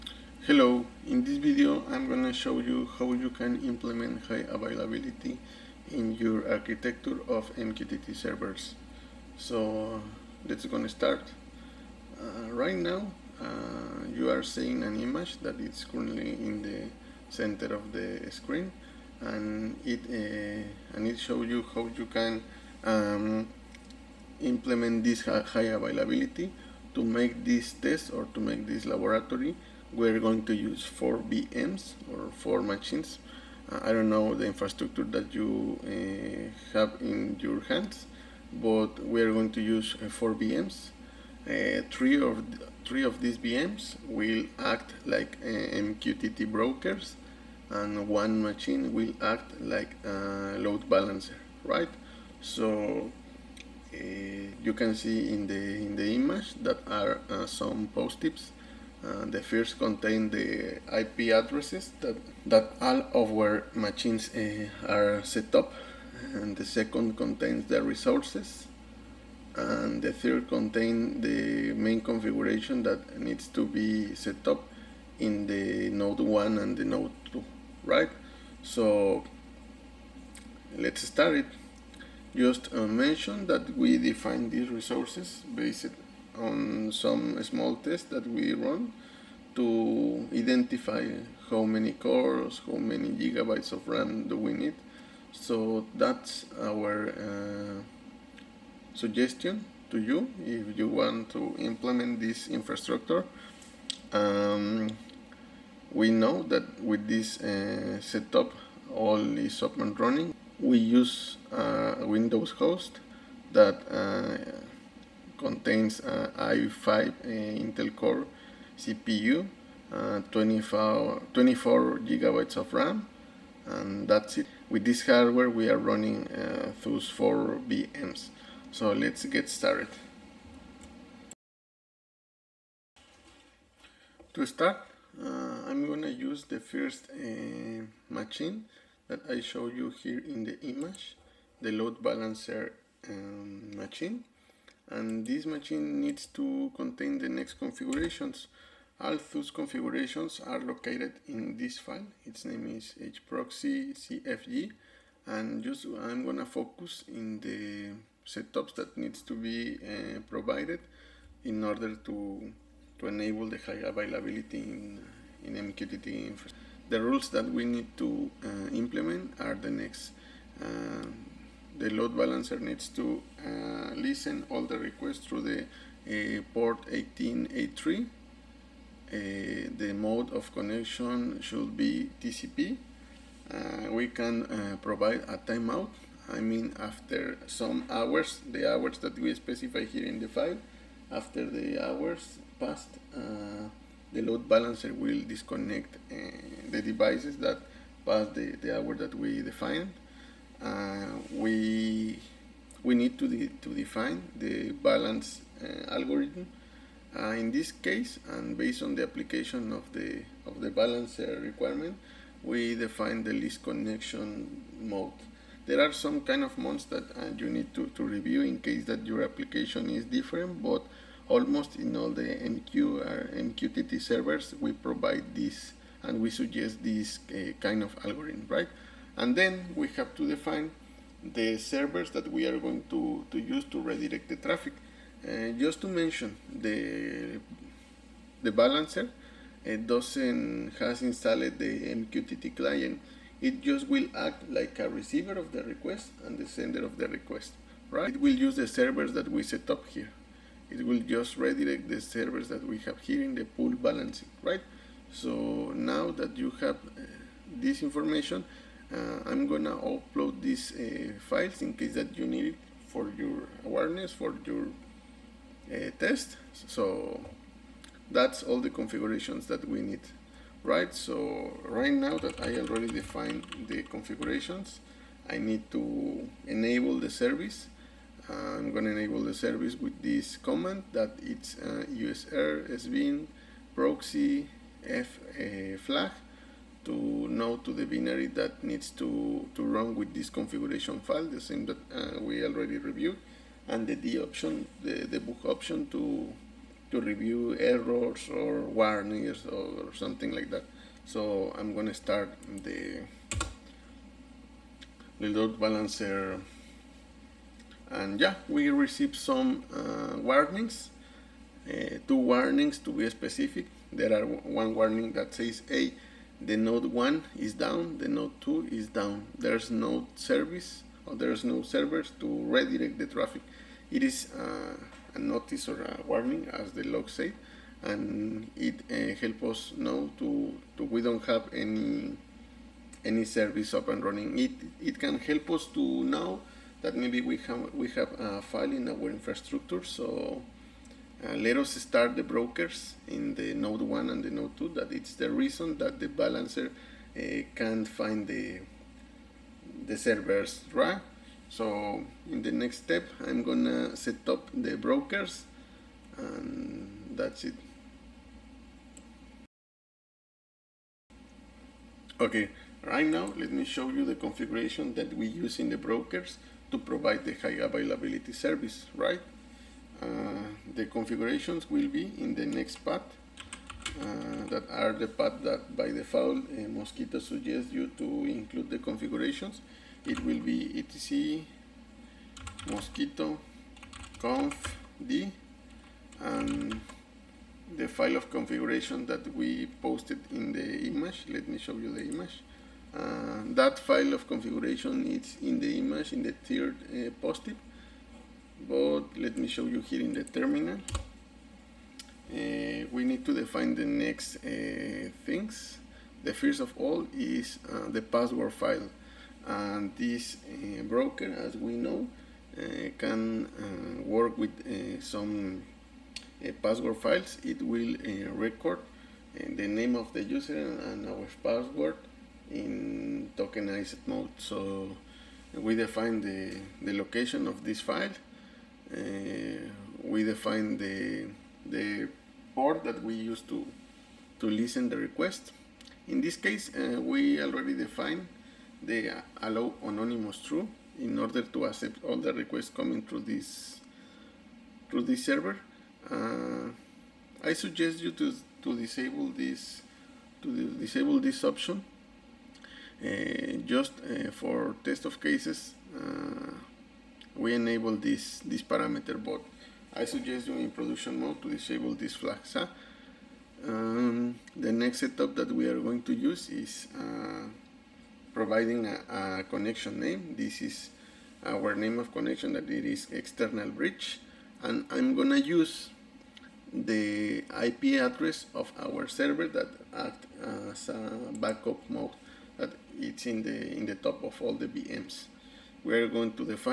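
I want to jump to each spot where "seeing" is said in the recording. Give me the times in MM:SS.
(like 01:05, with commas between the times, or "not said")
00:14.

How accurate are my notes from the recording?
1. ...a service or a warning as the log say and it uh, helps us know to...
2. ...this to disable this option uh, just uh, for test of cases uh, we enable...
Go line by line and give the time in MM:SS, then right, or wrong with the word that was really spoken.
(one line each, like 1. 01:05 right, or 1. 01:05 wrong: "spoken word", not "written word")
1. 05:25 wrong: "notice", not "service"
2. 07:29 right.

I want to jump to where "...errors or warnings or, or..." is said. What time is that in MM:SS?
04:57.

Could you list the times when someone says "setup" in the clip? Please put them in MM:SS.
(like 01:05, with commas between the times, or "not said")
01:48, 02:38, 07:44.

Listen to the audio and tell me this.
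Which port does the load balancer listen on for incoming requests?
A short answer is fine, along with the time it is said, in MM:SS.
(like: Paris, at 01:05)
1883, at 02:56.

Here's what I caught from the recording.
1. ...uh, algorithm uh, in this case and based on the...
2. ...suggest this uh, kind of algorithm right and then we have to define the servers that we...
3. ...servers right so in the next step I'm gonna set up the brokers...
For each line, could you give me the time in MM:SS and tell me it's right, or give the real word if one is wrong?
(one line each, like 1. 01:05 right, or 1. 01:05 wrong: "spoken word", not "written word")
1. 03:25 right
2. 03:46 right
3. 05:49 right.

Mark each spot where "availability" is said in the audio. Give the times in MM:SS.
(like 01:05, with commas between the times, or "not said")
00:04, 00:25, 02:43, 06:07.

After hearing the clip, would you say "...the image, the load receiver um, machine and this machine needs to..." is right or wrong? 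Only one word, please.
wrong.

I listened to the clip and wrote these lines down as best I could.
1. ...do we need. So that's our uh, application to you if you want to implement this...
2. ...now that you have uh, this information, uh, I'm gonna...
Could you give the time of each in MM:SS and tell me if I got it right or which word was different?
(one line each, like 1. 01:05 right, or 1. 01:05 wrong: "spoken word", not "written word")
1. 01:34 wrong: "suggestion", not "application"
2. 04:15 right.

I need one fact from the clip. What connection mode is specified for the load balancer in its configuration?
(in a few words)
TCP.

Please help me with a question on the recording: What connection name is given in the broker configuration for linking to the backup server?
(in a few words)
external bridge.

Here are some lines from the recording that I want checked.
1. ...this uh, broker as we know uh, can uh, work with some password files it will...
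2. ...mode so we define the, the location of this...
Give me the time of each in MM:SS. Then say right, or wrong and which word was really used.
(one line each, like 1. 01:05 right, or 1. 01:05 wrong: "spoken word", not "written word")
1. 06:49 right
2. 07:04 right.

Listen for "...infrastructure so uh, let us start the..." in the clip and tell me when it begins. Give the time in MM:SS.
05:39.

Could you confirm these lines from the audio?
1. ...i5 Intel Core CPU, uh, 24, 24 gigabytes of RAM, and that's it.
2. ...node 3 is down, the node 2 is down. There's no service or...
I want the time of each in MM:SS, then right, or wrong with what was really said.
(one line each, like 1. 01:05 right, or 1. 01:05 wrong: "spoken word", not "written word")
1. 01:56 right
2. 05:16 wrong: "1", not "3".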